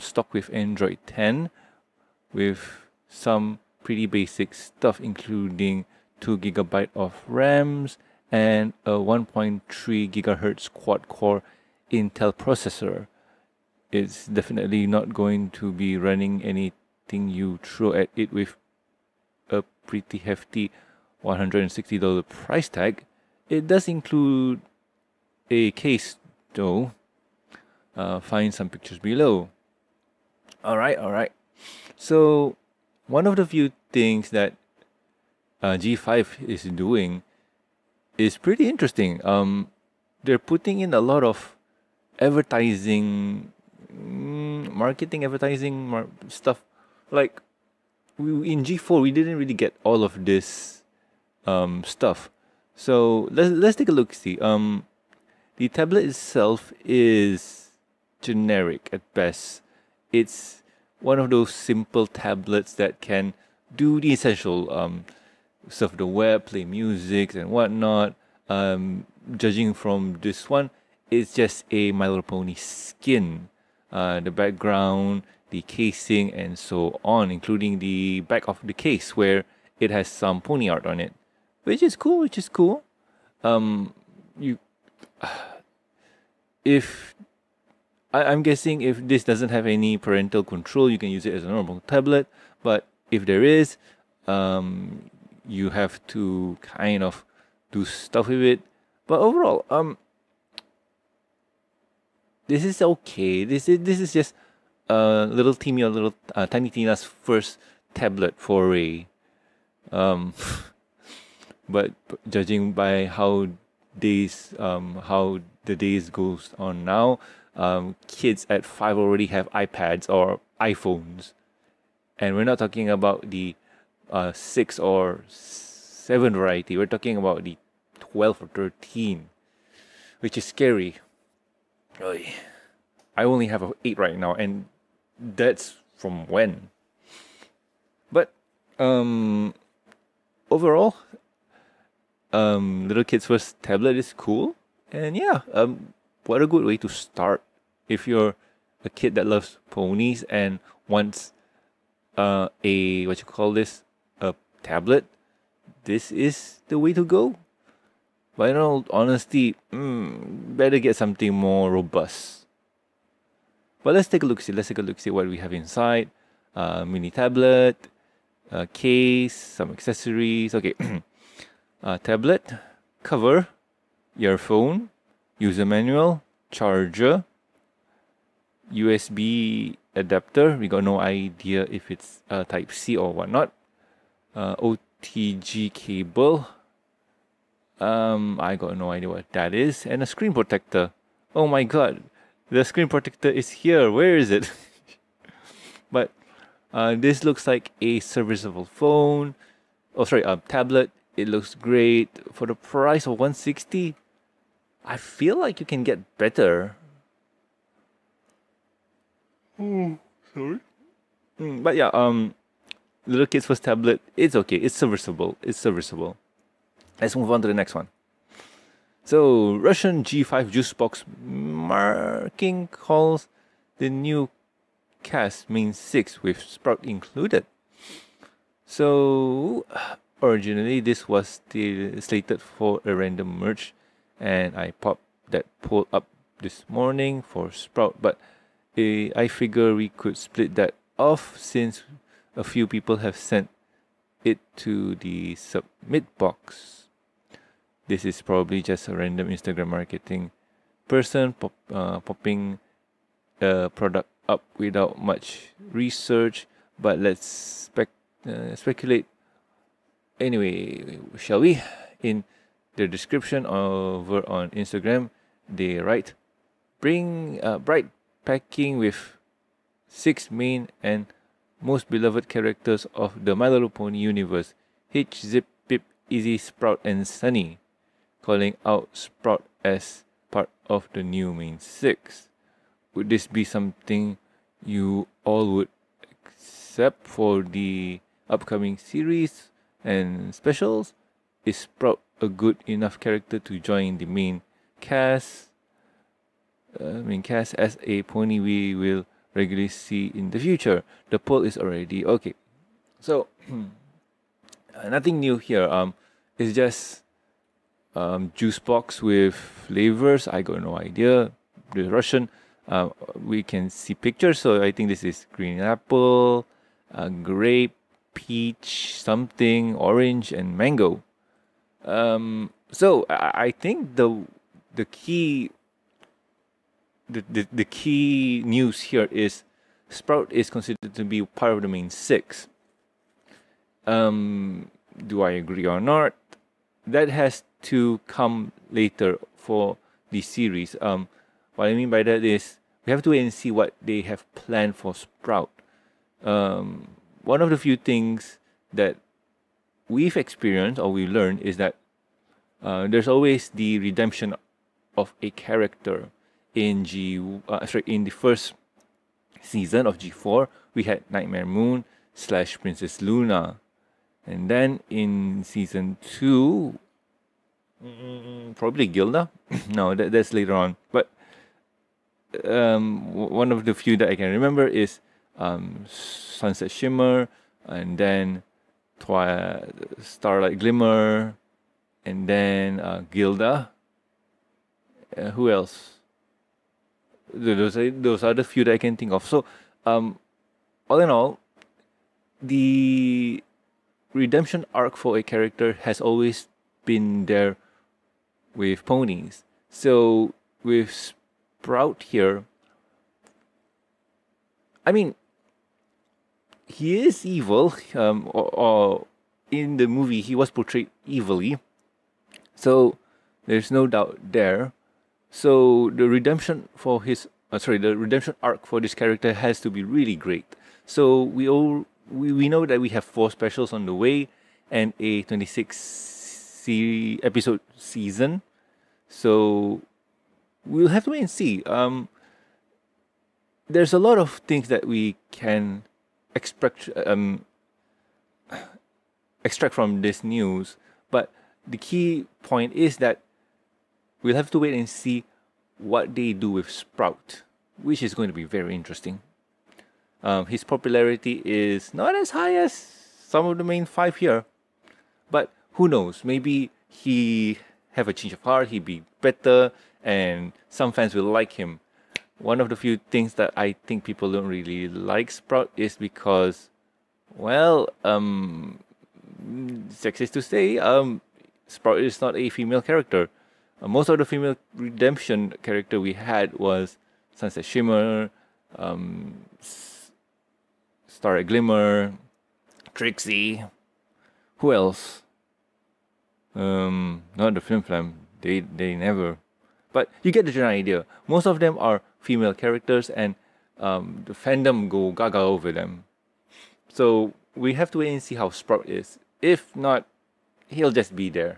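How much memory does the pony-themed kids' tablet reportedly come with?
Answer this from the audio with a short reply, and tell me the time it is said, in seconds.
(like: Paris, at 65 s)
2 GB RAM, at 6 s.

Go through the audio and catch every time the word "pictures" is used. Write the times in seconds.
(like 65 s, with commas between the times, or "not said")
28 s, 313 s.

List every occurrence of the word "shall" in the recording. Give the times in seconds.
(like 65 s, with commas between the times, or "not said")
261 s.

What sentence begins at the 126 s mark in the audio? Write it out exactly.
We're talking about the 12 or 13, which is scary.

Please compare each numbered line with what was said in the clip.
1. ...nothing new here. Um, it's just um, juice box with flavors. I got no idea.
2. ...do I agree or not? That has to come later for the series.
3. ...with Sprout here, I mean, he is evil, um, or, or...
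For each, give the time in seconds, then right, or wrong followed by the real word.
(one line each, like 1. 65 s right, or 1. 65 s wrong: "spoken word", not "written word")
1. 304 s right
2. 335 s right
3. 400 s right.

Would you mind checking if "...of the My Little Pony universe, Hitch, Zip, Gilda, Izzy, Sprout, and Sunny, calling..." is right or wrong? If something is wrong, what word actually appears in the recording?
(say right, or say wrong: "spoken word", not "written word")
wrong: "Pip", not "Gilda".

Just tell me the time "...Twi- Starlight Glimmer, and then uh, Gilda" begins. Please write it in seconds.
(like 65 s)
378 s.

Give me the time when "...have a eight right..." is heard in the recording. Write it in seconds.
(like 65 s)
133 s.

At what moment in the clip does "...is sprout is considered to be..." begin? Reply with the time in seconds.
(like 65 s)
329 s.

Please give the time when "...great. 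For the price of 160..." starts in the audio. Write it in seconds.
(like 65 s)
201 s.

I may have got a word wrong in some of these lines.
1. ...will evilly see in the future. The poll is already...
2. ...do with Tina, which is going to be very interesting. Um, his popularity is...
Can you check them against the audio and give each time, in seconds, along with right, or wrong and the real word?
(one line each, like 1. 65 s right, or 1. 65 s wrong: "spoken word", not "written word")
1. 298 s wrong: "regularly", not "evilly"
2. 446 s wrong: "Sprout", not "Tina".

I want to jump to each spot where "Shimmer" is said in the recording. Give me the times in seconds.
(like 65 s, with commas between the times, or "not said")
376 s, 477 s.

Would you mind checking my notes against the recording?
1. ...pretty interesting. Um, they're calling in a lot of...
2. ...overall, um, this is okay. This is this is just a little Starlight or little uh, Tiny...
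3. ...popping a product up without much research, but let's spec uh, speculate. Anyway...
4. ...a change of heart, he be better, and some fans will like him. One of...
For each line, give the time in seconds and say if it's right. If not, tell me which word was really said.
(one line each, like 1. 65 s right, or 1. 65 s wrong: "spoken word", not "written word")
1. 38 s wrong: "putting", not "calling"
2. 99 s wrong: "Timmy", not "Starlight"
3. 251 s right
4. 458 s right.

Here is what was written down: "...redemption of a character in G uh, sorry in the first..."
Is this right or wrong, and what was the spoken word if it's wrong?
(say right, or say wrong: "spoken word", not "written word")
right.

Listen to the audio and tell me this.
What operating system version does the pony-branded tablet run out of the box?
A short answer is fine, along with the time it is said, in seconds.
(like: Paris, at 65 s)
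Android 10, at 0 s.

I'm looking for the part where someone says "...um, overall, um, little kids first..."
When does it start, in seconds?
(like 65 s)
138 s.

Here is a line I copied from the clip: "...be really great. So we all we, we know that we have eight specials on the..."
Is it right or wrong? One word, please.
wrong.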